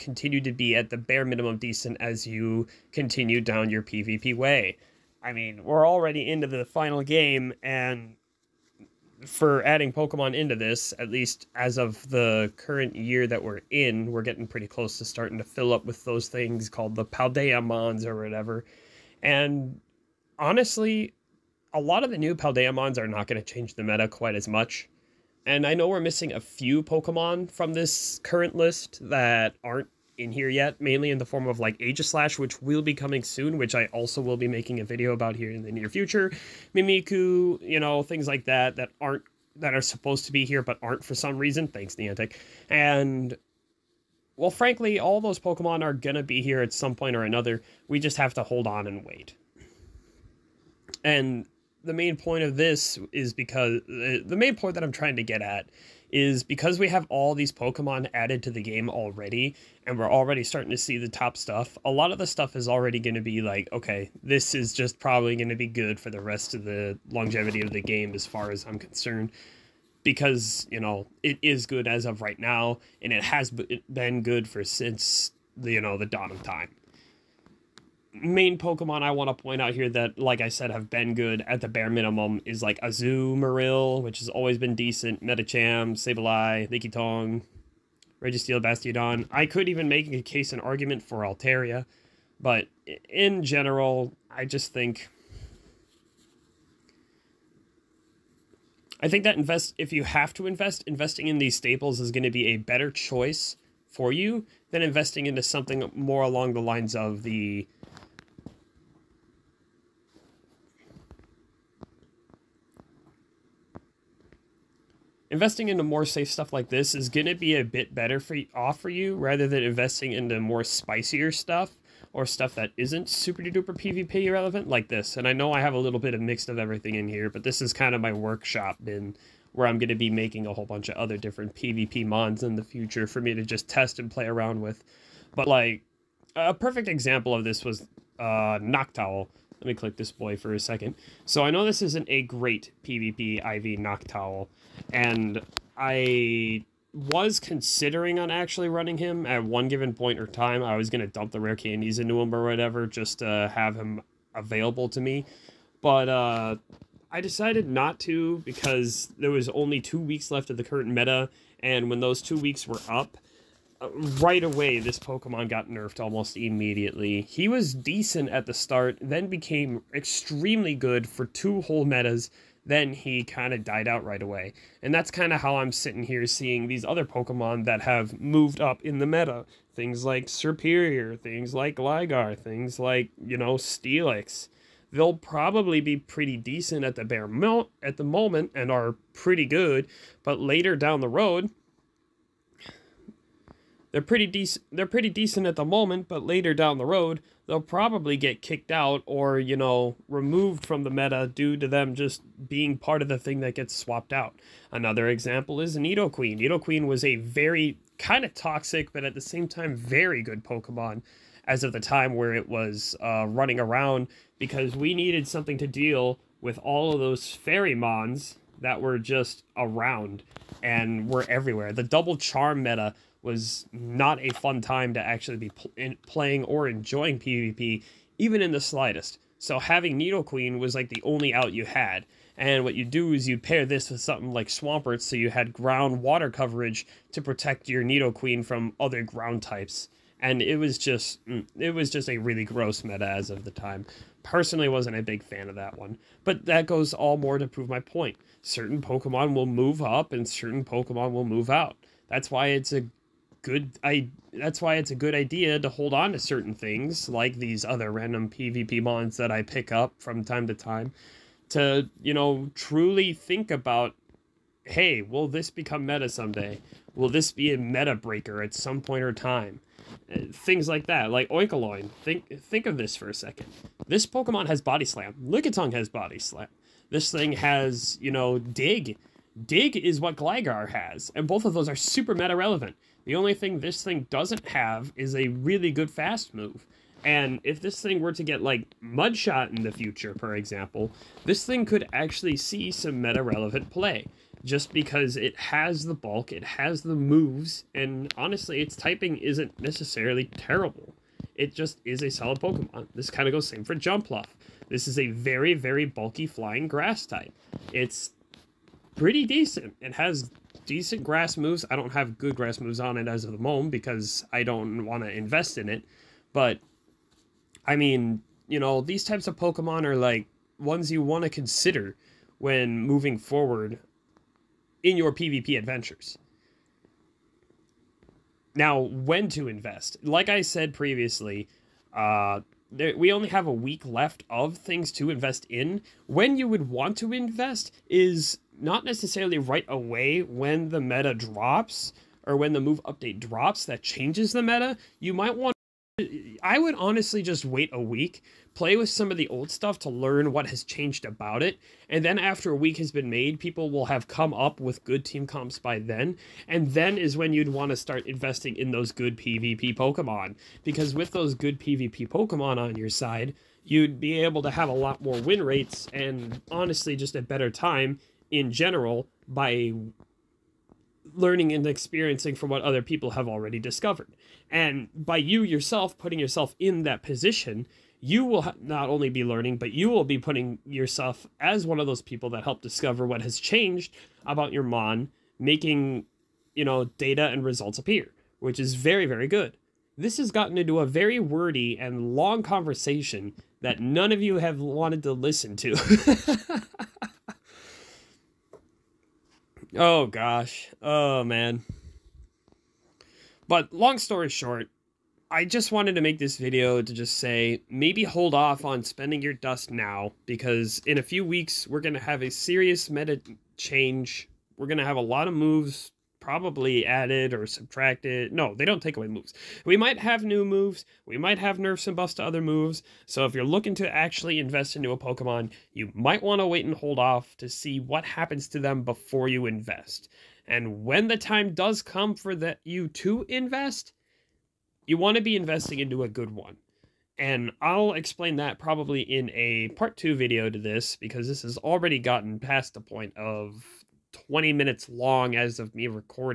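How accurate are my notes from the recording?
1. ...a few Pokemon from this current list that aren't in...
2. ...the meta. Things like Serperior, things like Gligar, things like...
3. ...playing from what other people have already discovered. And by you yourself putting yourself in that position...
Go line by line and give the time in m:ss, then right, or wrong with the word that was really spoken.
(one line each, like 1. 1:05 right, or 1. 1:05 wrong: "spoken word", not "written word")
1. 0:26 right
2. 2:58 right
3. 6:11 wrong: "experiencing", not "playing".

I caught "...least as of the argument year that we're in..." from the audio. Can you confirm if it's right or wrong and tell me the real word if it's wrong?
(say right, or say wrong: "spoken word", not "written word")
wrong: "current", not "argument".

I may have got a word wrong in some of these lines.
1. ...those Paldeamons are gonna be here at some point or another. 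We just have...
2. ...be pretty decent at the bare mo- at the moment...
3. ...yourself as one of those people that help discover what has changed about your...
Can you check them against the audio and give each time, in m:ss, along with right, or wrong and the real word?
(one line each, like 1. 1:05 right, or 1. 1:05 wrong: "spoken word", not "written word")
1. 0:45 wrong: "Pokemon", not "Paldeamons"
2. 3:05 right
3. 6:20 right.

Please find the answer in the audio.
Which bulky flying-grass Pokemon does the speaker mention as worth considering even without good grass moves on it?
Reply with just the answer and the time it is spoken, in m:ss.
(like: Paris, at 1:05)
Jumpluff, at 5:03.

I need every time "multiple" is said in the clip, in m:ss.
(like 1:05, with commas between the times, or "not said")
not said.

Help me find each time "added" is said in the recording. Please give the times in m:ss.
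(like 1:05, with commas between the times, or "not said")
0:58, 6:56.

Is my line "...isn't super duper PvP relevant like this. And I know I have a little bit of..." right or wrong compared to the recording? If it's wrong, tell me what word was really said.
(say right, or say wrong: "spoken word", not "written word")
right.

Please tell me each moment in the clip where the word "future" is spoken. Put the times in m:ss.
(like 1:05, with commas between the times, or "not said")
0:35, 2:12, 4:49.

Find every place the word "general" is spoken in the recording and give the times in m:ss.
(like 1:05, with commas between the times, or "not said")
1:33, 6:08.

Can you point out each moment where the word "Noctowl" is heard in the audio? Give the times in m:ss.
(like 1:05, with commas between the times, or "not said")
2:18, 2:23.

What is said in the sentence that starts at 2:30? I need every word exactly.
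I was going to dump the rare candies into him or whatever just to have him available to me.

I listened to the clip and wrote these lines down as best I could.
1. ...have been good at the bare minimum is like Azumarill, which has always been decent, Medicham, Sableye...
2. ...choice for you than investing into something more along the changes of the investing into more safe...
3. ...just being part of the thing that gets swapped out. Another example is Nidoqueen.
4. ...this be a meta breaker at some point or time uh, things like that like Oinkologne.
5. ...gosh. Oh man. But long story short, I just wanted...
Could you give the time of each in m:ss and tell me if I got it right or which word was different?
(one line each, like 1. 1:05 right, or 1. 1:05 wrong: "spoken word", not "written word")
1. 1:20 right
2. 1:42 wrong: "lines", not "changes"
3. 3:21 right
4. 4:27 right
5. 6:40 right.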